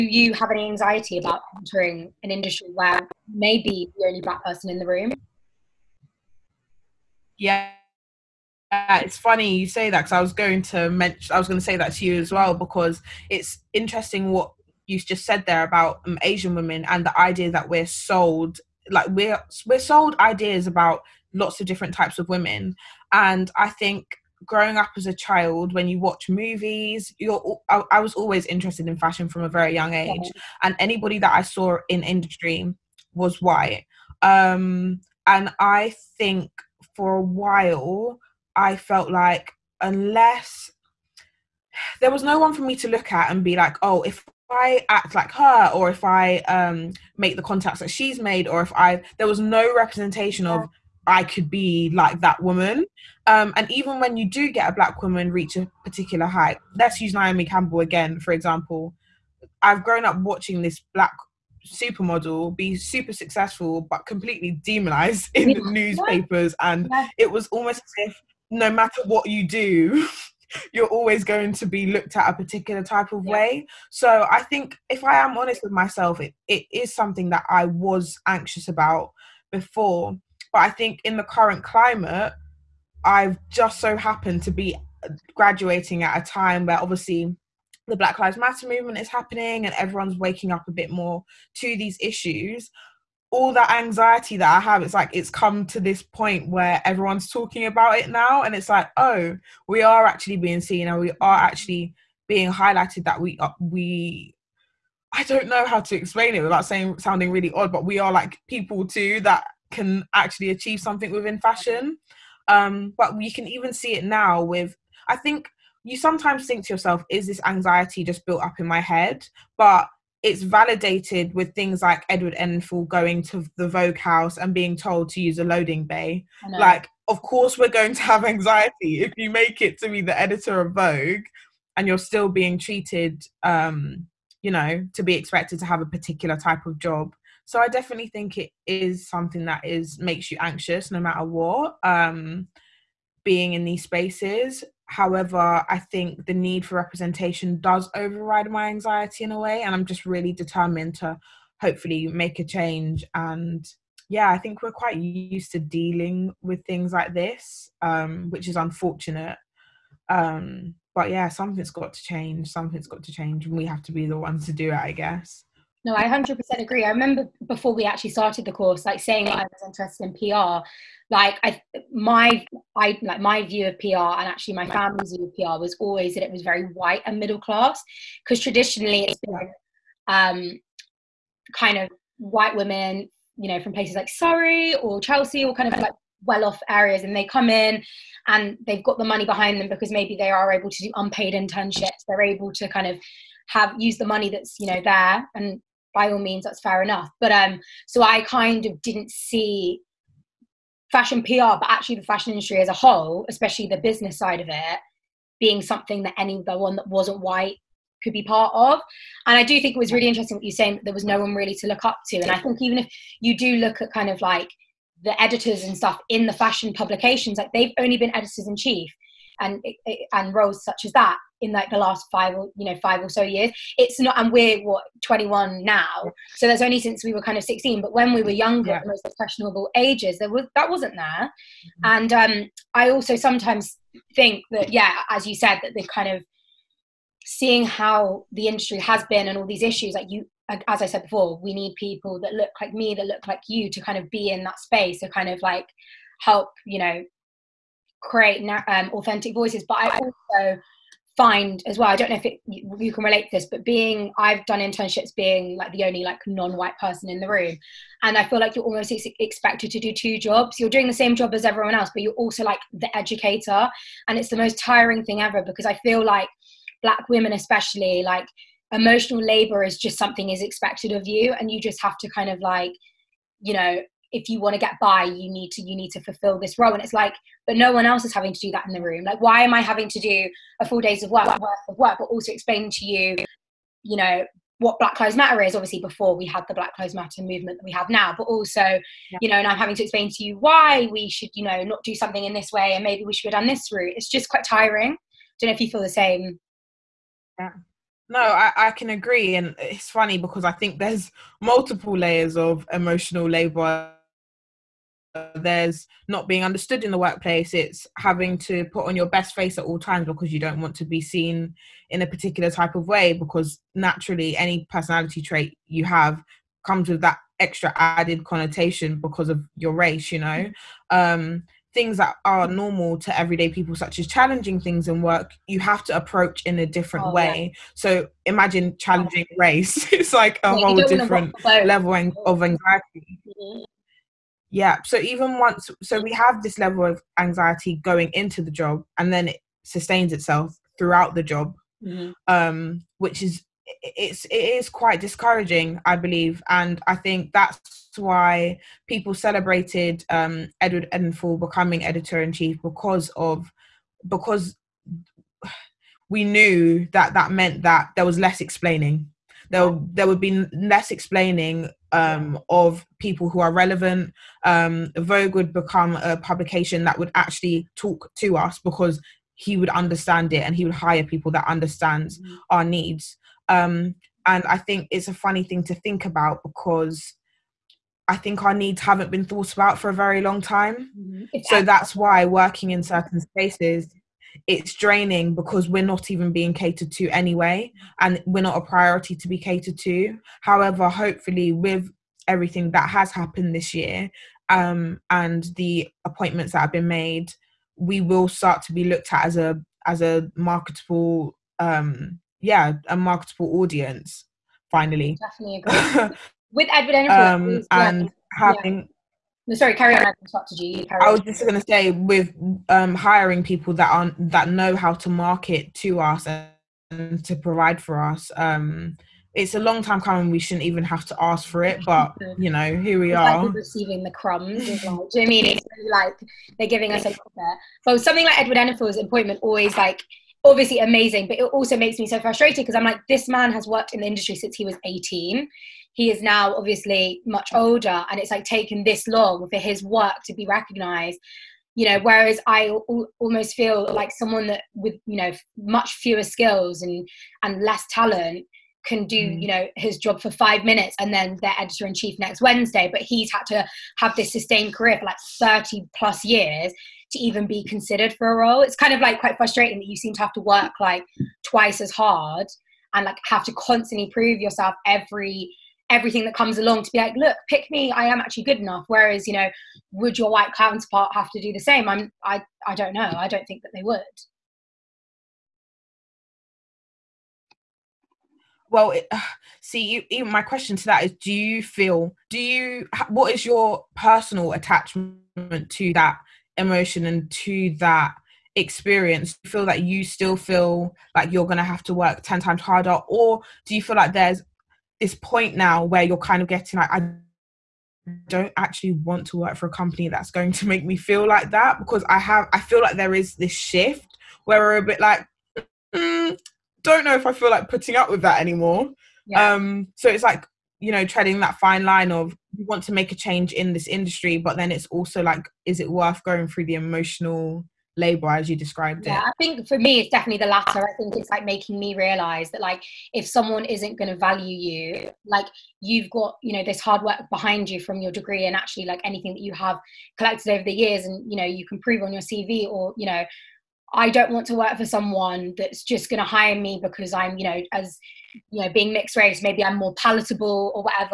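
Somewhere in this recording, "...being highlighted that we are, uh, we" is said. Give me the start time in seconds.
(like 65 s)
102 s.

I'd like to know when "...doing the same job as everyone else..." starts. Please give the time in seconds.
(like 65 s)
260 s.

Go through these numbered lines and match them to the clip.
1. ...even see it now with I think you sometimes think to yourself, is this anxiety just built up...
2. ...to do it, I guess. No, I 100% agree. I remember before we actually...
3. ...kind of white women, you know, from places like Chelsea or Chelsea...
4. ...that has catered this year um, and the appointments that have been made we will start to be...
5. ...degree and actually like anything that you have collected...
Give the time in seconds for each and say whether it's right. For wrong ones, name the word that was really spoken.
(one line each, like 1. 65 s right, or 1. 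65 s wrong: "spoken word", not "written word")
1. 113 s right
2. 164 s right
3. 181 s wrong: "Surrey", not "Chelsea"
4. 392 s wrong: "happened", not "catered"
5. 528 s right.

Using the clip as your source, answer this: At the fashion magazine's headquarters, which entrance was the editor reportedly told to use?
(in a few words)
loading bay.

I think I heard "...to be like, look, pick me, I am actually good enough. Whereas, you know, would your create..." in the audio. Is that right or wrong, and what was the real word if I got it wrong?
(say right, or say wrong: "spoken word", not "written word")
wrong: "white", not "create".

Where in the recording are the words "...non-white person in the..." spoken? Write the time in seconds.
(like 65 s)
256 s.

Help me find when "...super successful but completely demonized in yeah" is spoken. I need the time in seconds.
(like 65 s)
62 s.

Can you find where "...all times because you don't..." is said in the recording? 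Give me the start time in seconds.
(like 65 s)
309 s.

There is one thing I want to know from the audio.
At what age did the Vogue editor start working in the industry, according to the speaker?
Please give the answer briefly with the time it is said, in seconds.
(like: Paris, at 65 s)
18, at 434 s.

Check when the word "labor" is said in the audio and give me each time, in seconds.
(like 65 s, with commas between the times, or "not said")
269 s, 303 s, 517 s.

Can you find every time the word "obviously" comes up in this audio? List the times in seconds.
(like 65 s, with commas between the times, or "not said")
86 s, 285 s, 430 s, 436 s.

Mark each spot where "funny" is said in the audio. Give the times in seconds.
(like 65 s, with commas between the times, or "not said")
9 s, 299 s, 375 s.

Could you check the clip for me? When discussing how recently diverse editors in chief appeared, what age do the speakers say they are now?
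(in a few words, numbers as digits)
21.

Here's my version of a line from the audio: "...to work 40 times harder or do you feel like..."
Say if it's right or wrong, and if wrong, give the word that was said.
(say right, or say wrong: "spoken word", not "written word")
wrong: "10", not "40".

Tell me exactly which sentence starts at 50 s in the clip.
of I could be like that woman.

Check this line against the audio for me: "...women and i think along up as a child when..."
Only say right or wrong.
wrong.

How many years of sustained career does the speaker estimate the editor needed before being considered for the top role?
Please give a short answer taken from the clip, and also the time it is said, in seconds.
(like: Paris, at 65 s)
30 plus, at 455 s.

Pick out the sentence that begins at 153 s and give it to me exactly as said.
And yeah, I think we're quite used to dealing with things like this, um, which is unfortunate.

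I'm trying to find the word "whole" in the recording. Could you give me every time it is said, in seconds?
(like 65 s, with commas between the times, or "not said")
202 s, 330 s.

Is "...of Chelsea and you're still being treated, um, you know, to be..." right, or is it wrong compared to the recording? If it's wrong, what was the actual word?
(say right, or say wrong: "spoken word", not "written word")
wrong: "Vogue", not "Chelsea".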